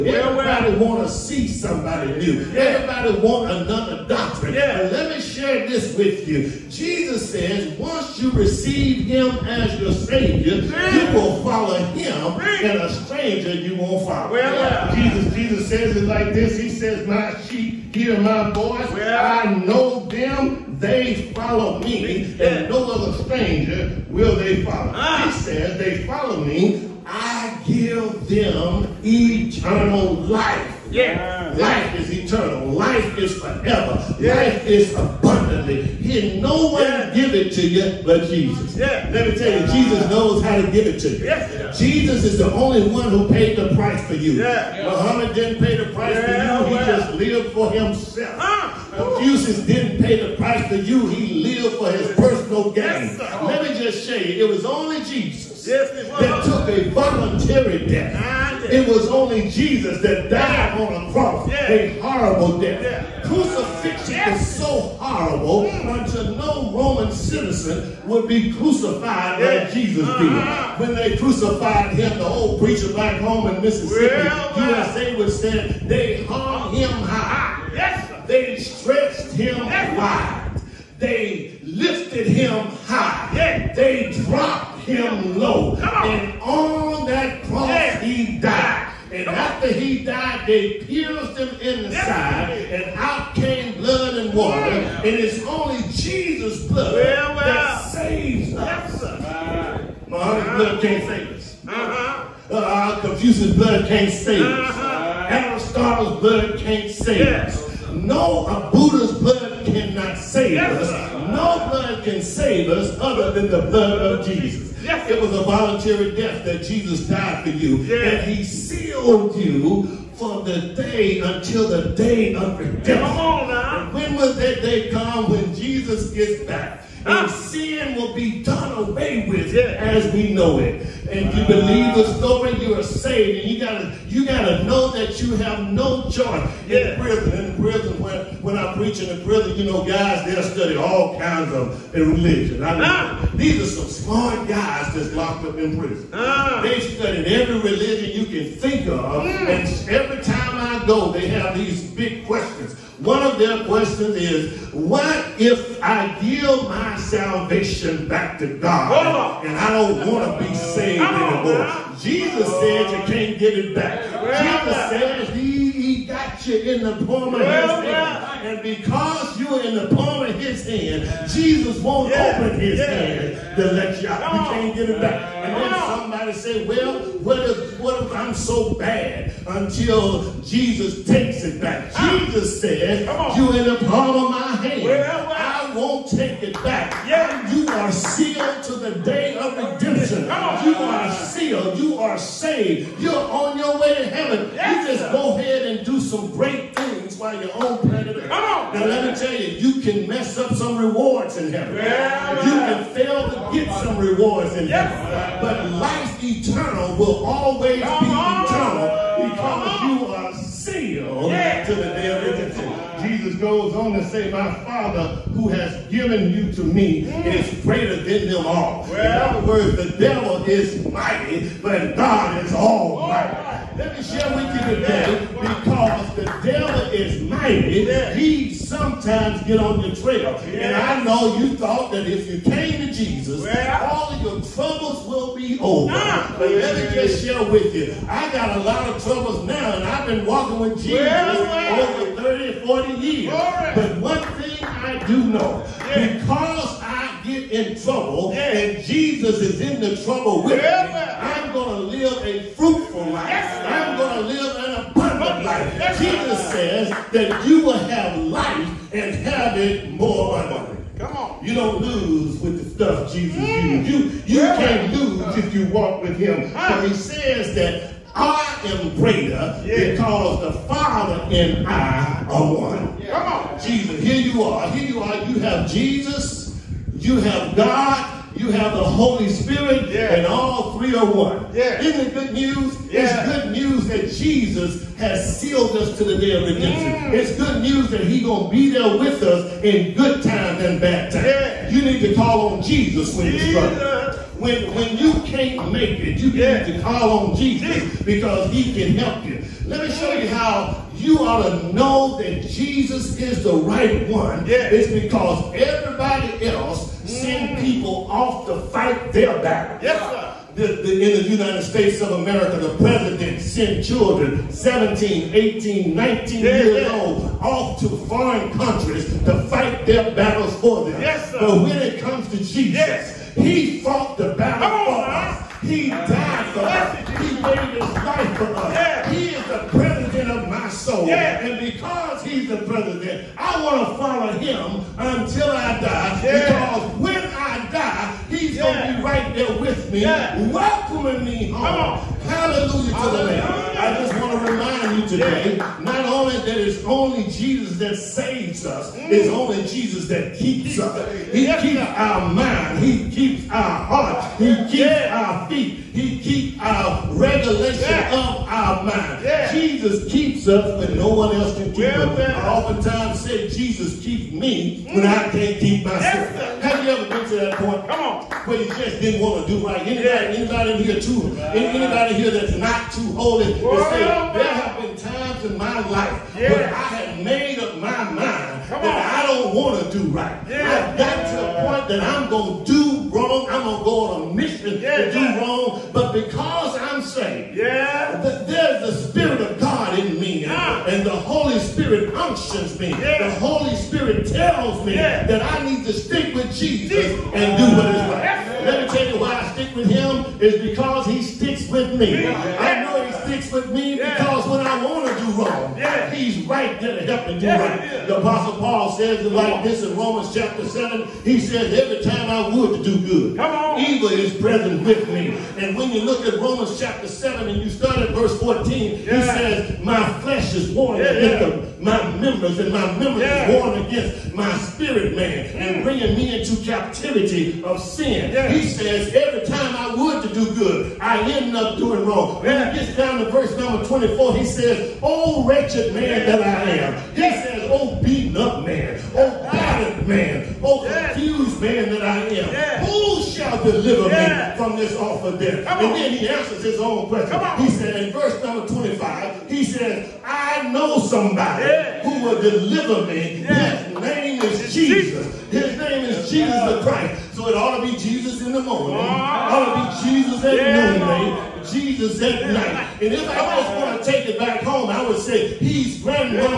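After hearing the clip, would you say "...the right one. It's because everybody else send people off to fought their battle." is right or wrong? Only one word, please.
wrong.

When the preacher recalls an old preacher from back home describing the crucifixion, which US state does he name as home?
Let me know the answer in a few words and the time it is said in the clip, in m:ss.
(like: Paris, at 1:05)
Mississippi, at 1:13.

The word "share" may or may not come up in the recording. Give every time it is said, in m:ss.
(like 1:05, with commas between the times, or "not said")
0:05, 3:44, 3:57.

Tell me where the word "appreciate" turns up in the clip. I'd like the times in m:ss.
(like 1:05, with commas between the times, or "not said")
not said.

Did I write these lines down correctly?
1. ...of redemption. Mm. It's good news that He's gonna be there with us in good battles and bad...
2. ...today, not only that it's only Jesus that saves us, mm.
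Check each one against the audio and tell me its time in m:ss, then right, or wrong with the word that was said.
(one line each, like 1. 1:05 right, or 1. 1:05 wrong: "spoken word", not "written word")
1. 4:46 wrong: "times", not "battles"
2. 5:45 right.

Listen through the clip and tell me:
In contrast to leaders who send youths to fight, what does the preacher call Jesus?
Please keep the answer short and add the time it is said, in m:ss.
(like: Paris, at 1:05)
president of my soul, at 5:29.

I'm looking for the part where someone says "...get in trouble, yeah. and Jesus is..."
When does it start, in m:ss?
4:07.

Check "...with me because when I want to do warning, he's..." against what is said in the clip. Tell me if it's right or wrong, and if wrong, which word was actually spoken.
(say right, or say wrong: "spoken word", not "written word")
wrong: "wrong", not "warning".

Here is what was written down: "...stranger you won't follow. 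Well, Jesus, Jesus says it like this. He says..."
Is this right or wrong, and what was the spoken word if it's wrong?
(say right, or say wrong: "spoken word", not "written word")
right.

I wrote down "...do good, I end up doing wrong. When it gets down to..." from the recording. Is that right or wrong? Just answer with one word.
right.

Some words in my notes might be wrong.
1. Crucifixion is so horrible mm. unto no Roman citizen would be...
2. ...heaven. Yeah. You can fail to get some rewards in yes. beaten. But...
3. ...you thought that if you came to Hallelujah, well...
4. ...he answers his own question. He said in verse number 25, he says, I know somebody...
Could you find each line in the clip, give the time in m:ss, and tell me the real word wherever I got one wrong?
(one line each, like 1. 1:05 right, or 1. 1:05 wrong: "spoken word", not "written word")
1. 1:03 right
2. 3:21 wrong: "heaven", not "beaten"
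3. 3:51 wrong: "Jesus", not "Hallelujah"
4. 7:26 right.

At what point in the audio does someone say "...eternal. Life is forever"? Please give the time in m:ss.
0:32.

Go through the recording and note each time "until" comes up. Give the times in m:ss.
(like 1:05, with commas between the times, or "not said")
2:01, 2:59, 5:34.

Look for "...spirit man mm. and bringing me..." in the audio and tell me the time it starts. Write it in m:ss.
7:04.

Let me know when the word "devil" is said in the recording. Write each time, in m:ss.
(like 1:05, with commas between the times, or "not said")
3:39, 3:46.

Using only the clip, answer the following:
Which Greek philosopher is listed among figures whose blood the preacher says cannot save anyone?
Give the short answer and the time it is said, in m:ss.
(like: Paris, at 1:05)
Aristotle, at 1:45.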